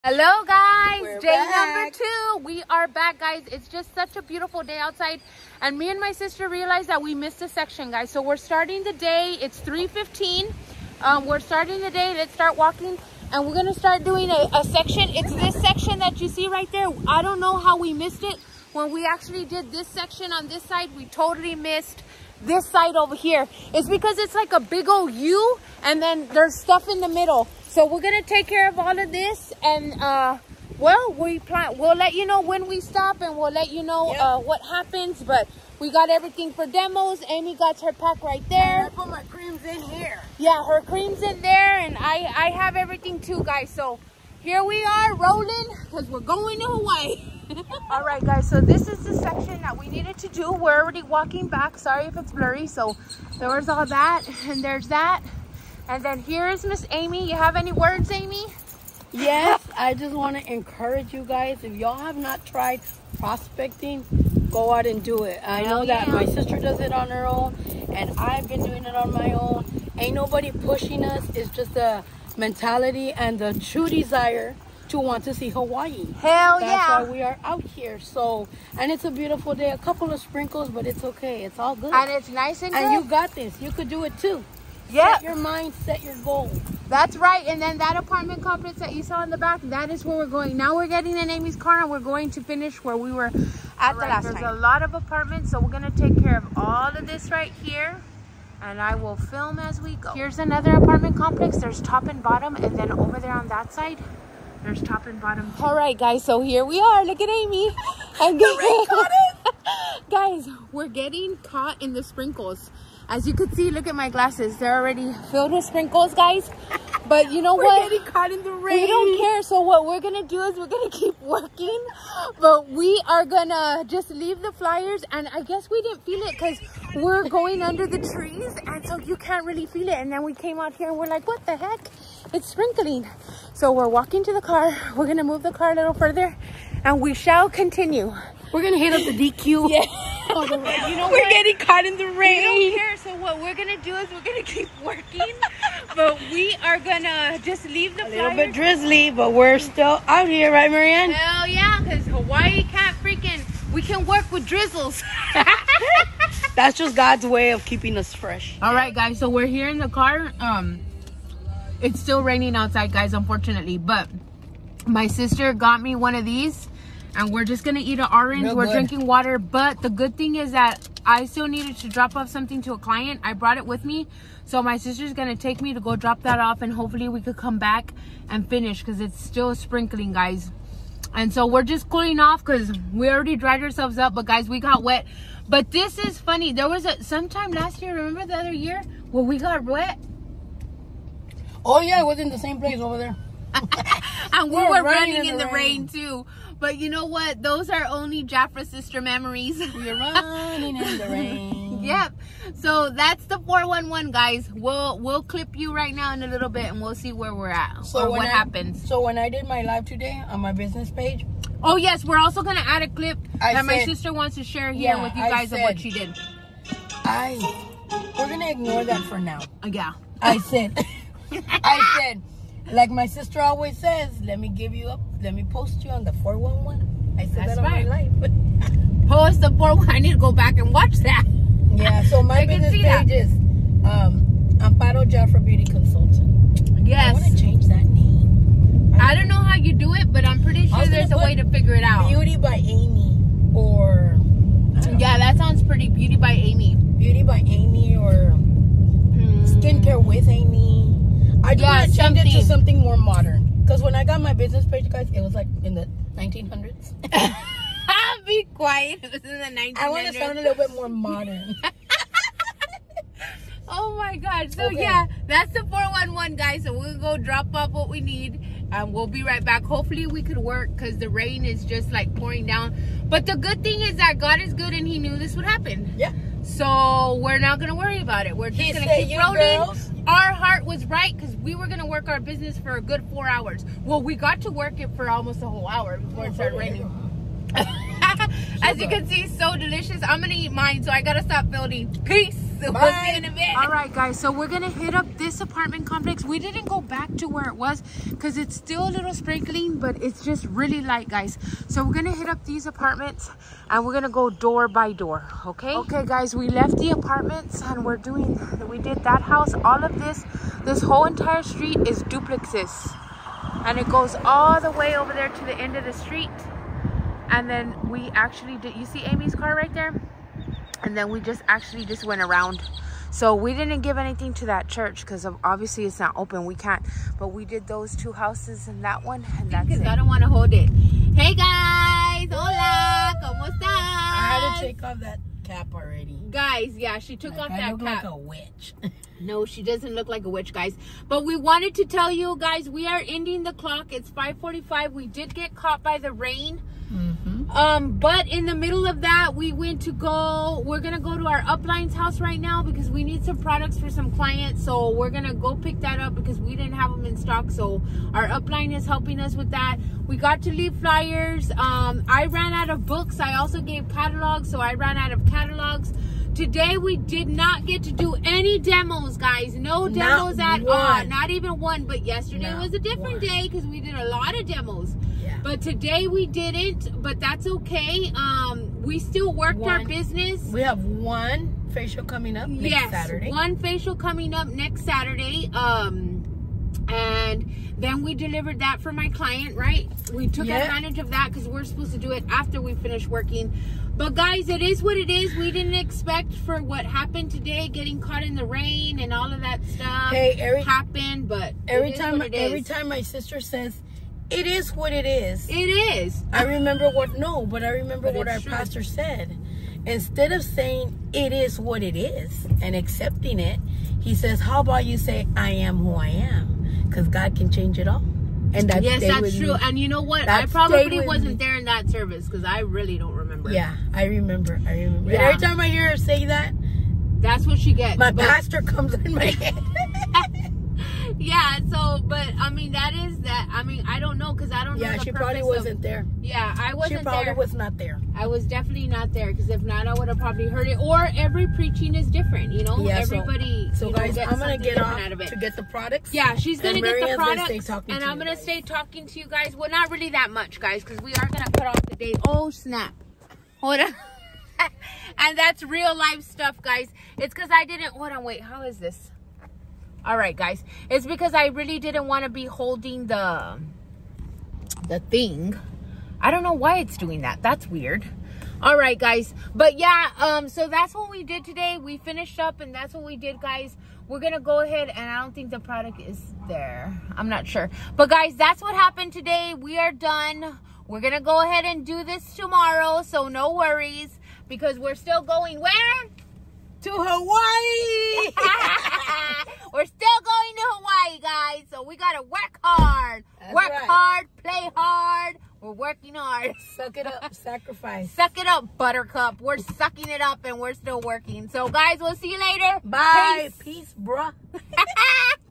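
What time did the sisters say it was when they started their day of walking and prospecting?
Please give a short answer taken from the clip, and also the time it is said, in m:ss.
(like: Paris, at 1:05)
3:15, at 0:09.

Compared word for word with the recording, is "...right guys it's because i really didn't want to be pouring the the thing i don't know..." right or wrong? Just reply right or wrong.
wrong.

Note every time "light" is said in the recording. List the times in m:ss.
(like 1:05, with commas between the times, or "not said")
5:00.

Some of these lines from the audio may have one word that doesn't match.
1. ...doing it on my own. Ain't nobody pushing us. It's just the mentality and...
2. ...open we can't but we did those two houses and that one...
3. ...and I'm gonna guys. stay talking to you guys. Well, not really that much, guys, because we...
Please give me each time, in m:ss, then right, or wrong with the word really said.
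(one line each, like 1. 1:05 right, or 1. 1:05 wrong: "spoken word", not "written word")
1. 1:08 right
2. 5:26 right
3. 7:27 right.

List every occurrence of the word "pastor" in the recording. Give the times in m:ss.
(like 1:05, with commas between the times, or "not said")
6:48, 7:08.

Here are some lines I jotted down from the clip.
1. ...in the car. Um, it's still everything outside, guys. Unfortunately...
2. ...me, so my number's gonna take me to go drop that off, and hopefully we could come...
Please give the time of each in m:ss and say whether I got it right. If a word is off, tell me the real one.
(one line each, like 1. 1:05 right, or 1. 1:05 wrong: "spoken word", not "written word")
1. 2:39 wrong: "raining", not "everything"
2. 2:53 wrong: "sister", not "number".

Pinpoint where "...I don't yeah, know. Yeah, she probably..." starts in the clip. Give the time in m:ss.
7:14.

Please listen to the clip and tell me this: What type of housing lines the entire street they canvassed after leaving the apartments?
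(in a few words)
Duplexes.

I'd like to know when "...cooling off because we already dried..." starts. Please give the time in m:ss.
3:01.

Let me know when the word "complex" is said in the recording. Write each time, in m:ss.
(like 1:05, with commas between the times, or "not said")
1:28, 1:41, 4:55.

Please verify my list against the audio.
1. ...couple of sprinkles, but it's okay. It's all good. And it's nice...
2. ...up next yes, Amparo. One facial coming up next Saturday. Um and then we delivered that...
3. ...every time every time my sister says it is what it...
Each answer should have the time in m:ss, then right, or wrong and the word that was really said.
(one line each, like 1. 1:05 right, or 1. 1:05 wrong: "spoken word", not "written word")
1. 1:19 right
2. 6:22 wrong: "Saturday", not "Amparo"
3. 6:41 right.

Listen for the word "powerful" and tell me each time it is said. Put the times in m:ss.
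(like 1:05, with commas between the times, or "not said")
not said.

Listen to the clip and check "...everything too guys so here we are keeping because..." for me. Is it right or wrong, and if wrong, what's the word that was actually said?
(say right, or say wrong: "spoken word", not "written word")
wrong: "rolling", not "keeping".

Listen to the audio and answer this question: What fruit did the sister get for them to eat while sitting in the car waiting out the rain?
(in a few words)
Orange.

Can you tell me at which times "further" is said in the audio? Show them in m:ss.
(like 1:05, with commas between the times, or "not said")
2:15.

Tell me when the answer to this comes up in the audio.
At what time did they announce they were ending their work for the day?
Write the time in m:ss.
5:43.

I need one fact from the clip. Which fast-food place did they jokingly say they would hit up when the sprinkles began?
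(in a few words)
DQ.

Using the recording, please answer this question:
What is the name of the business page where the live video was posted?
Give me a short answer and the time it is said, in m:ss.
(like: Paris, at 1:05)
Amparo Jafra Beauty Consultant, at 3:54.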